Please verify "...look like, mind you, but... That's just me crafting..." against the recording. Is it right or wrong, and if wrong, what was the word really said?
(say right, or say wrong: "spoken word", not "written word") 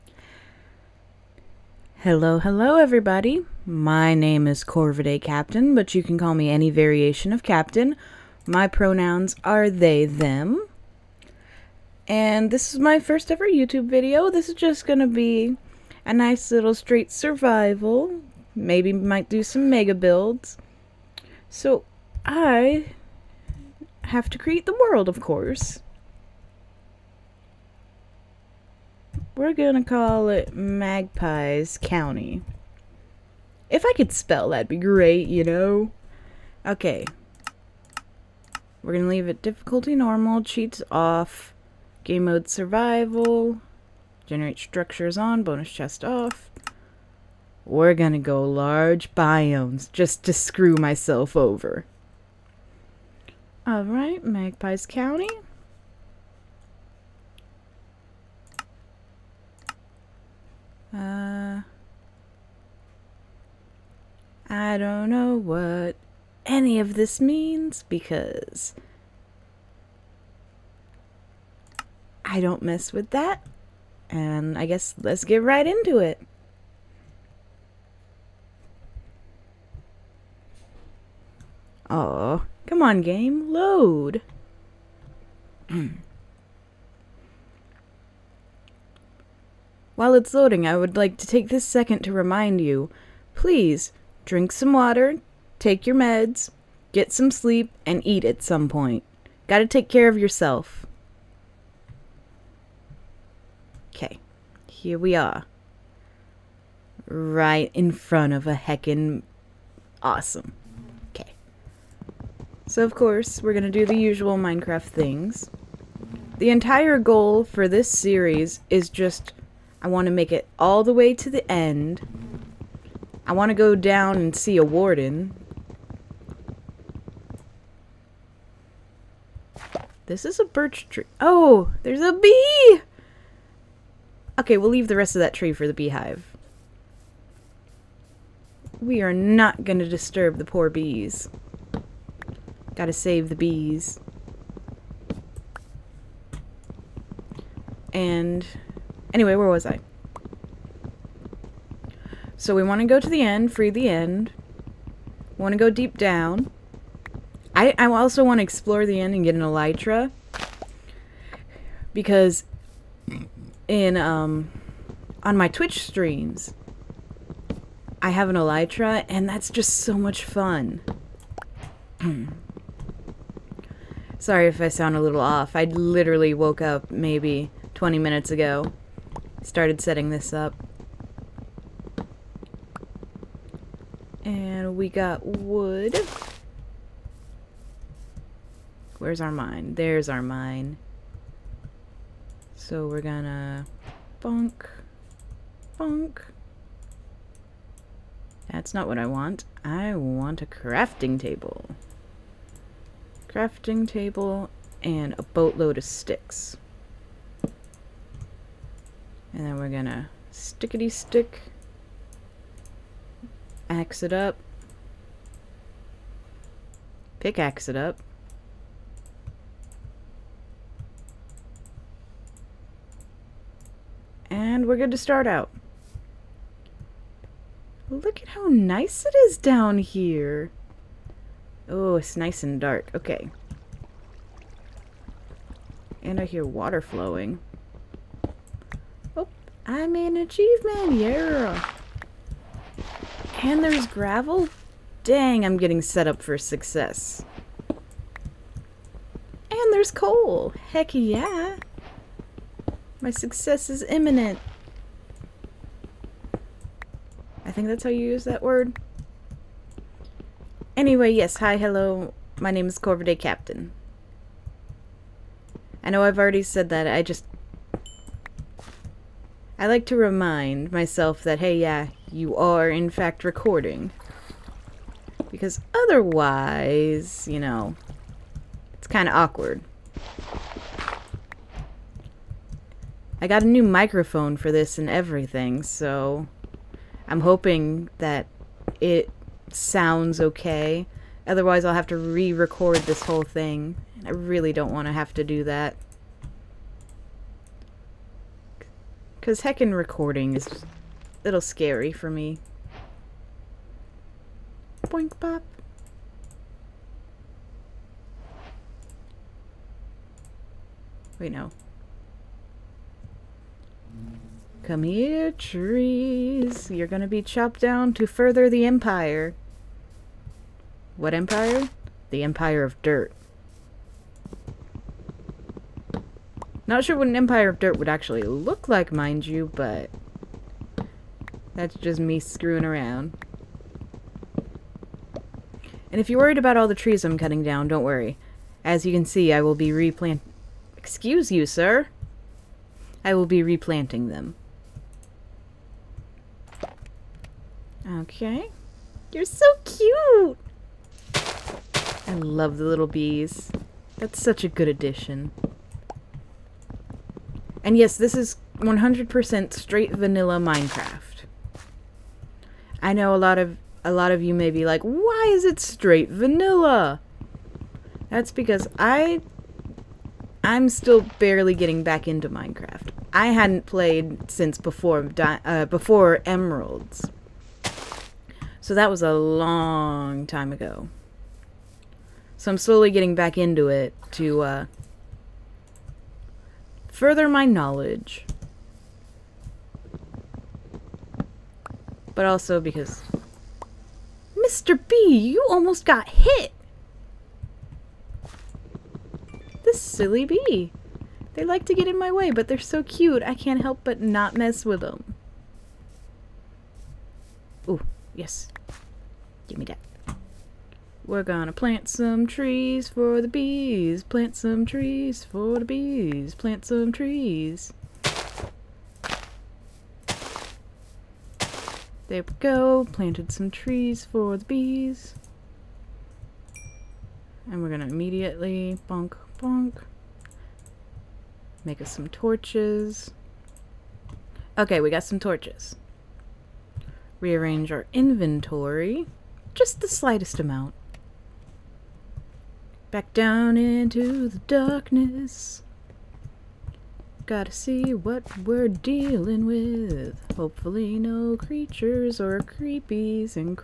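wrong: "screwing", not "crafting".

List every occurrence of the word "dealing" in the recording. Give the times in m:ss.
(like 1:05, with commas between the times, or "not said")
7:28.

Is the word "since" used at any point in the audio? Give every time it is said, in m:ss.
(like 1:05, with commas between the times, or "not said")
6:14.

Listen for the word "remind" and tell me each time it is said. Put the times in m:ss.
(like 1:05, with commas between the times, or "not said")
1:32, 4:29.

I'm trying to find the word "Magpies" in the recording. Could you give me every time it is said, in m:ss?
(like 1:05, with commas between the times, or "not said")
0:30, 0:54.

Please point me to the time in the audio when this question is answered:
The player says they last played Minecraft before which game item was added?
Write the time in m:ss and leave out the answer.
6:16.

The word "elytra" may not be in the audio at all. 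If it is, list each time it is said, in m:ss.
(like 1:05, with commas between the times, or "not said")
2:39, 2:48.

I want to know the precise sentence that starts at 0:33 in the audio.
If I could spell, that'd be great, you know?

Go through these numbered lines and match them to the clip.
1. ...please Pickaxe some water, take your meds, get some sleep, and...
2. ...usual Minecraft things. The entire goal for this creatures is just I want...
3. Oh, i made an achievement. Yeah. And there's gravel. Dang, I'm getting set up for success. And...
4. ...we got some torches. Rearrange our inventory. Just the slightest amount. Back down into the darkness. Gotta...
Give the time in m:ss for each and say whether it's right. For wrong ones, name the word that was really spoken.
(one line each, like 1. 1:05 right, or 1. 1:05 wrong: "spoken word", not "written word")
1. 1:33 wrong: "Drink", not "Pickaxe"
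2. 1:53 wrong: "series", not "creatures"
3. 3:59 right
4. 7:14 right.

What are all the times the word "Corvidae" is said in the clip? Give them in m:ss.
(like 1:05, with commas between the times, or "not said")
0:04, 4:22.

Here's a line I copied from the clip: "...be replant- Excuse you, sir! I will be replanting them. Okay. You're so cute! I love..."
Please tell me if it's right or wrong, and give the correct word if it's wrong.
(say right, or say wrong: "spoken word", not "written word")
right.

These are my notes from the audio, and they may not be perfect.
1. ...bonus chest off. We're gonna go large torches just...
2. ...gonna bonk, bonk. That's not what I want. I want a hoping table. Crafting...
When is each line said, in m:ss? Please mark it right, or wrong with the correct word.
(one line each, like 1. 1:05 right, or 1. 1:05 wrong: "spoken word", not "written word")
1. 0:45 wrong: "biomes", not "torches"
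2. 3:13 wrong: "crafting", not "hoping".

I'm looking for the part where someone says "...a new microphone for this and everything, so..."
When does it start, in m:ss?
4:43.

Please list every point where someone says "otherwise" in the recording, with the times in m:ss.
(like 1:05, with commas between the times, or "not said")
4:35, 4:51.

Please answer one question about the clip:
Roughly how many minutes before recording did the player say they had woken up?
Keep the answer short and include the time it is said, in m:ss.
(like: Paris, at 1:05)
20, at 2:57.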